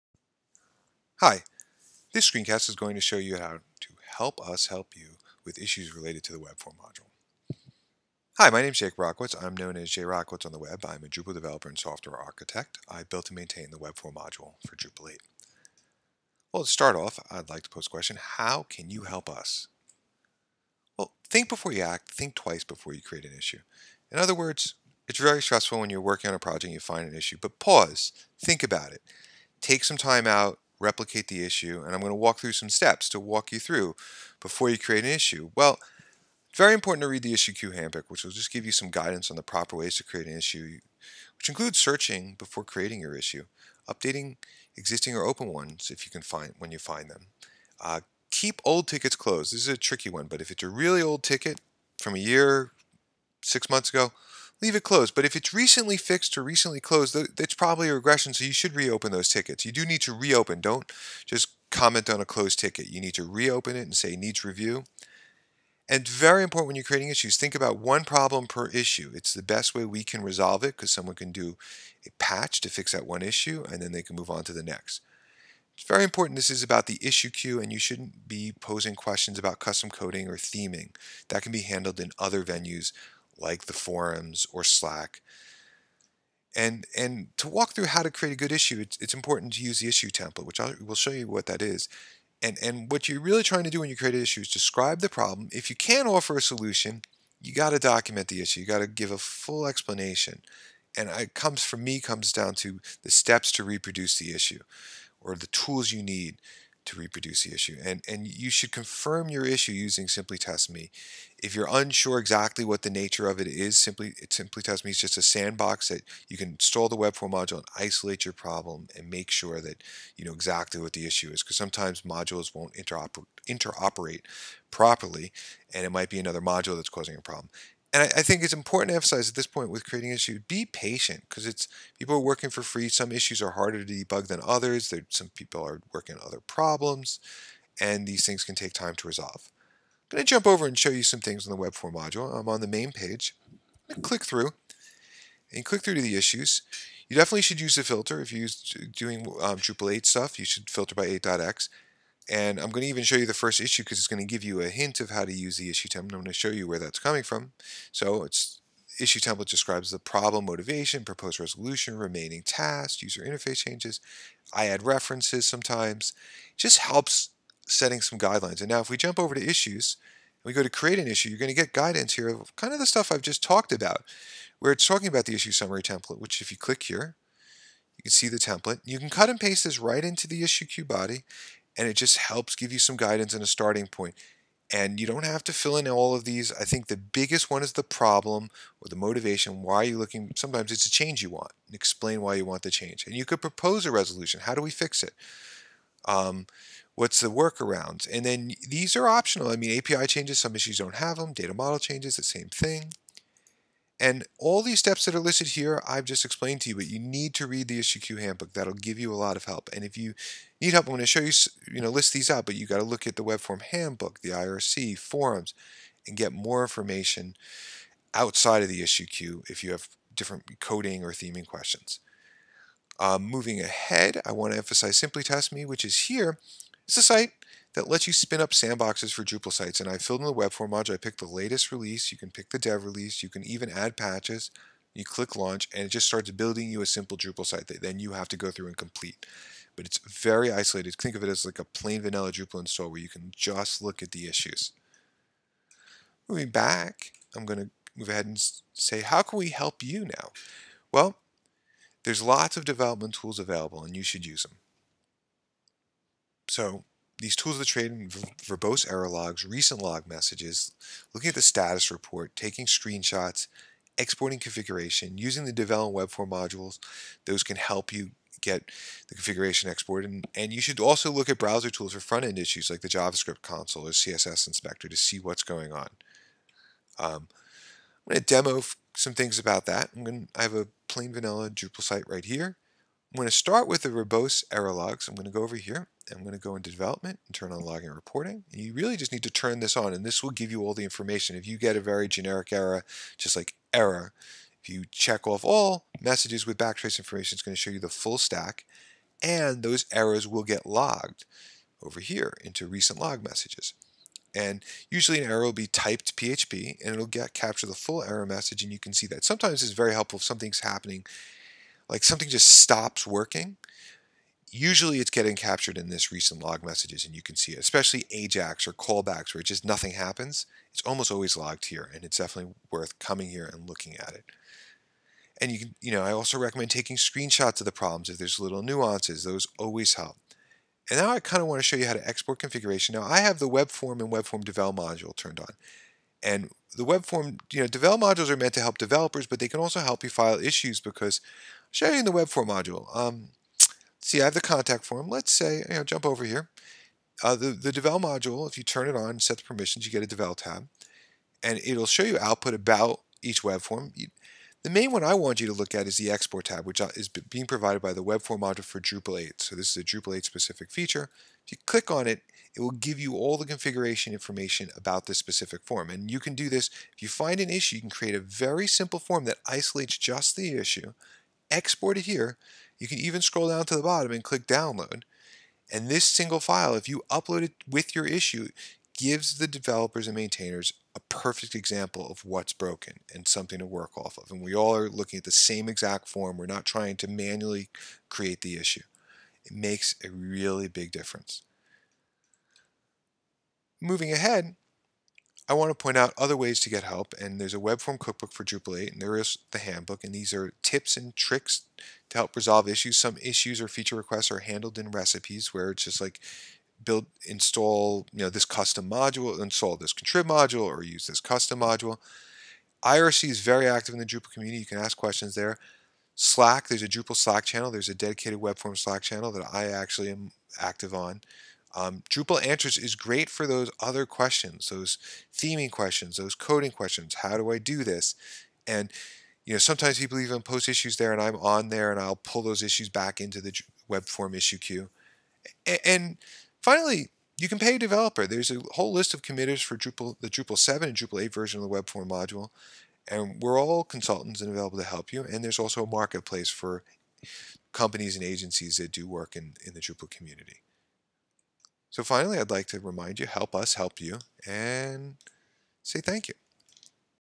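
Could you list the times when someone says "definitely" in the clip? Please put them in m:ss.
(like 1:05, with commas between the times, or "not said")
2:27, 5:22.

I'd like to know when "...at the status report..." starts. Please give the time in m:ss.
4:21.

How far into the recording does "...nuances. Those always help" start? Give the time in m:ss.
5:28.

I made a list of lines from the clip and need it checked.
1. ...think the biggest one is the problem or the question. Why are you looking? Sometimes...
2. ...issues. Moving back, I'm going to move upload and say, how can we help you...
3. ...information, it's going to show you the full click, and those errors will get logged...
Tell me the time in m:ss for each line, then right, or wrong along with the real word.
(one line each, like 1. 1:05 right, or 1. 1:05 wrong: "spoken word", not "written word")
1. 3:06 wrong: "motivation", not "question"
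2. 4:04 wrong: "ahead", not "upload"
3. 4:56 wrong: "stack", not "click".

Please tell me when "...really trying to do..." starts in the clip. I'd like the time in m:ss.
1:33.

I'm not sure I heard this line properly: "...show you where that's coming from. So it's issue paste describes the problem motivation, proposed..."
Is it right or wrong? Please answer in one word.
wrong.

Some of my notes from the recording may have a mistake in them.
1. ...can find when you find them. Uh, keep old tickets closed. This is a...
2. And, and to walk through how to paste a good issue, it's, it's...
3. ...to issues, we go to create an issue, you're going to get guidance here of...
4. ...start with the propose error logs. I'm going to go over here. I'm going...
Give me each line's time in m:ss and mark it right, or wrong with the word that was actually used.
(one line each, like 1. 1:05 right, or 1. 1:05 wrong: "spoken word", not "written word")
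1. 0:46 right
2. 1:26 wrong: "create", not "paste"
3. 2:49 right
4. 4:43 wrong: "verbose", not "propose".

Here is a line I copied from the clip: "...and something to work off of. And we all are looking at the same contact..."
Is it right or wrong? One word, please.
wrong.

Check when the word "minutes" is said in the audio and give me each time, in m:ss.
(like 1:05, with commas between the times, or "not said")
not said.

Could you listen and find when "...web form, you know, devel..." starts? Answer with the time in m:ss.
5:36.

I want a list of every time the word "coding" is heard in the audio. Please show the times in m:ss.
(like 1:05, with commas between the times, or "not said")
1:19, 3:40, 7:06.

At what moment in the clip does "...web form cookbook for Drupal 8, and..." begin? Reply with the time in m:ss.
6:37.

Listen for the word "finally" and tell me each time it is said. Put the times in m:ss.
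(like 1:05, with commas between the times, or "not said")
7:16, 7:32.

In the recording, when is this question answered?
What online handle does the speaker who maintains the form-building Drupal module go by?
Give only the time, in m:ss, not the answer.
0:09.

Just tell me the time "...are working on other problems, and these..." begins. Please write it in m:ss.
2:15.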